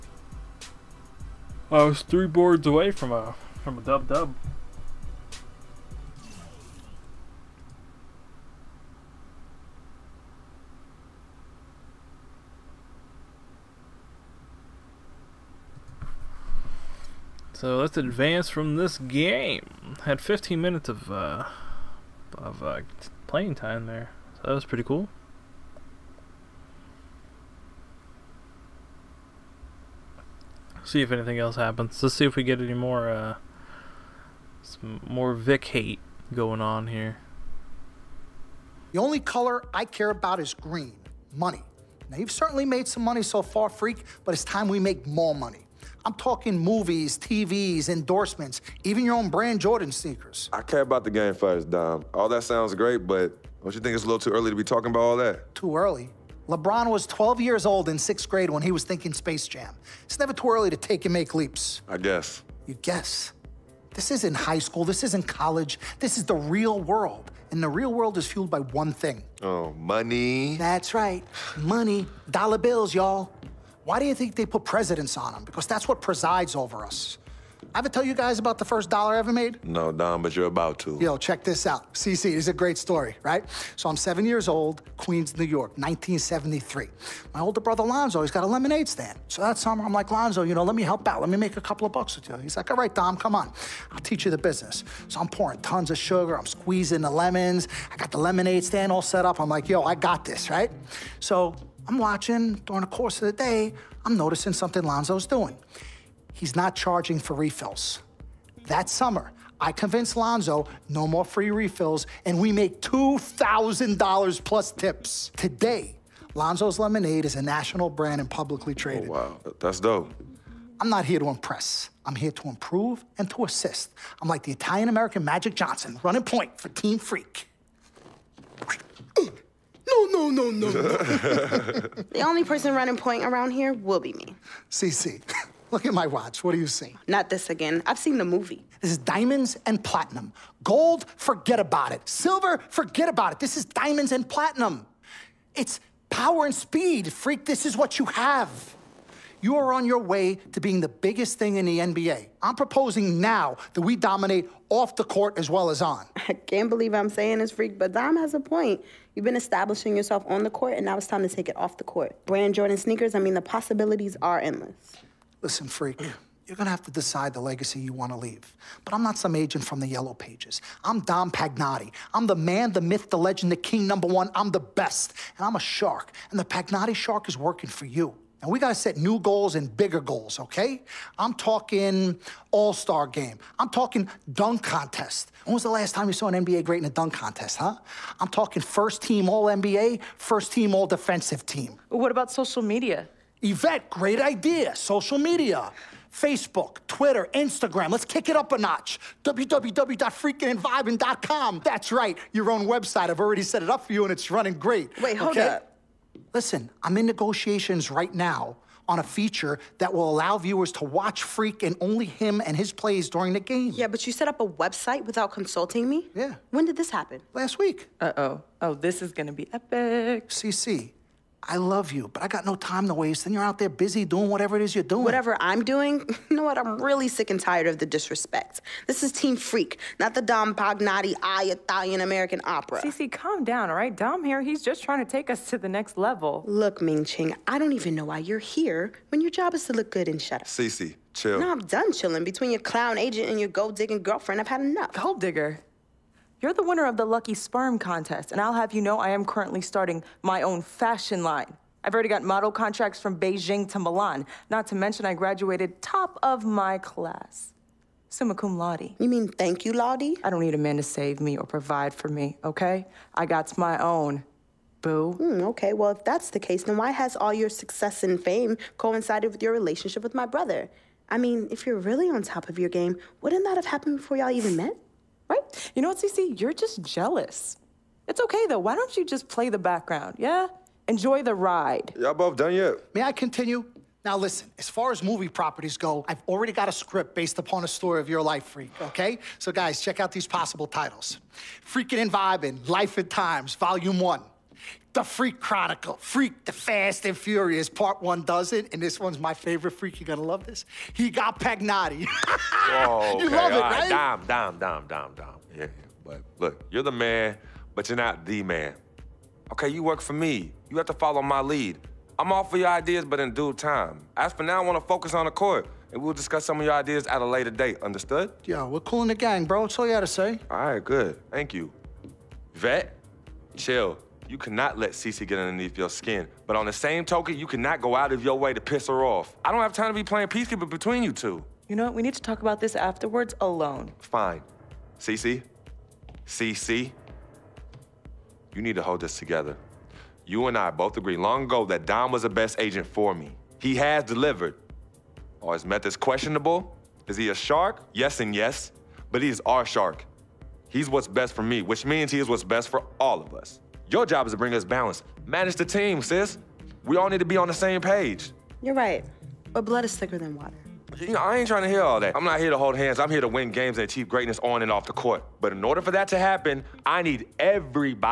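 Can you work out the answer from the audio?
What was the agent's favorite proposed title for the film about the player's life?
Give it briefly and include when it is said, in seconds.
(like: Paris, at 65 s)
He got Pagnotti, at 300 s.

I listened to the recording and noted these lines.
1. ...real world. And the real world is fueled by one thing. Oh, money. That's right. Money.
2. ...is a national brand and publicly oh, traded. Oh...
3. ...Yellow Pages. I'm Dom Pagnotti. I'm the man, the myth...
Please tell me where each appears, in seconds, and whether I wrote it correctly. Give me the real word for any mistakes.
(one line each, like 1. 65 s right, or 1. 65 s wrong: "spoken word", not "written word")
1. 66 s right
2. 117 s right
3. 169 s right.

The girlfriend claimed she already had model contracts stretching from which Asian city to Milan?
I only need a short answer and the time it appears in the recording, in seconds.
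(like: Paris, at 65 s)
Beijing, at 253 s.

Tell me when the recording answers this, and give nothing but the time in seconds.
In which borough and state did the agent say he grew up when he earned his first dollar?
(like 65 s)
84 s.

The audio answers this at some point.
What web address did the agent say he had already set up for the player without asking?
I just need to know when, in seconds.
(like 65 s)
199 s.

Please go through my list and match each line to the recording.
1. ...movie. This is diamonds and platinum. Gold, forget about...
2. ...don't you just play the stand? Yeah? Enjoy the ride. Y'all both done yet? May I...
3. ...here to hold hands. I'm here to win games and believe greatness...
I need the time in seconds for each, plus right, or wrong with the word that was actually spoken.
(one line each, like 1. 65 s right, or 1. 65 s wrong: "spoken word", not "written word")
1. 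138 s right
2. 278 s wrong: "background", not "stand"
3. 362 s wrong: "achieve", not "believe".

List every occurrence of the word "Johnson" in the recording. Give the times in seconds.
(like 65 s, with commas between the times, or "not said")
125 s.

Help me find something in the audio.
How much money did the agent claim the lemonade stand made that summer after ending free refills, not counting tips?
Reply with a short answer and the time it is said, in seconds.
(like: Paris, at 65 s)
$2,000, at 112 s.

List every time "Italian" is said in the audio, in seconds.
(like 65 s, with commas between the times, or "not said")
124 s, 231 s.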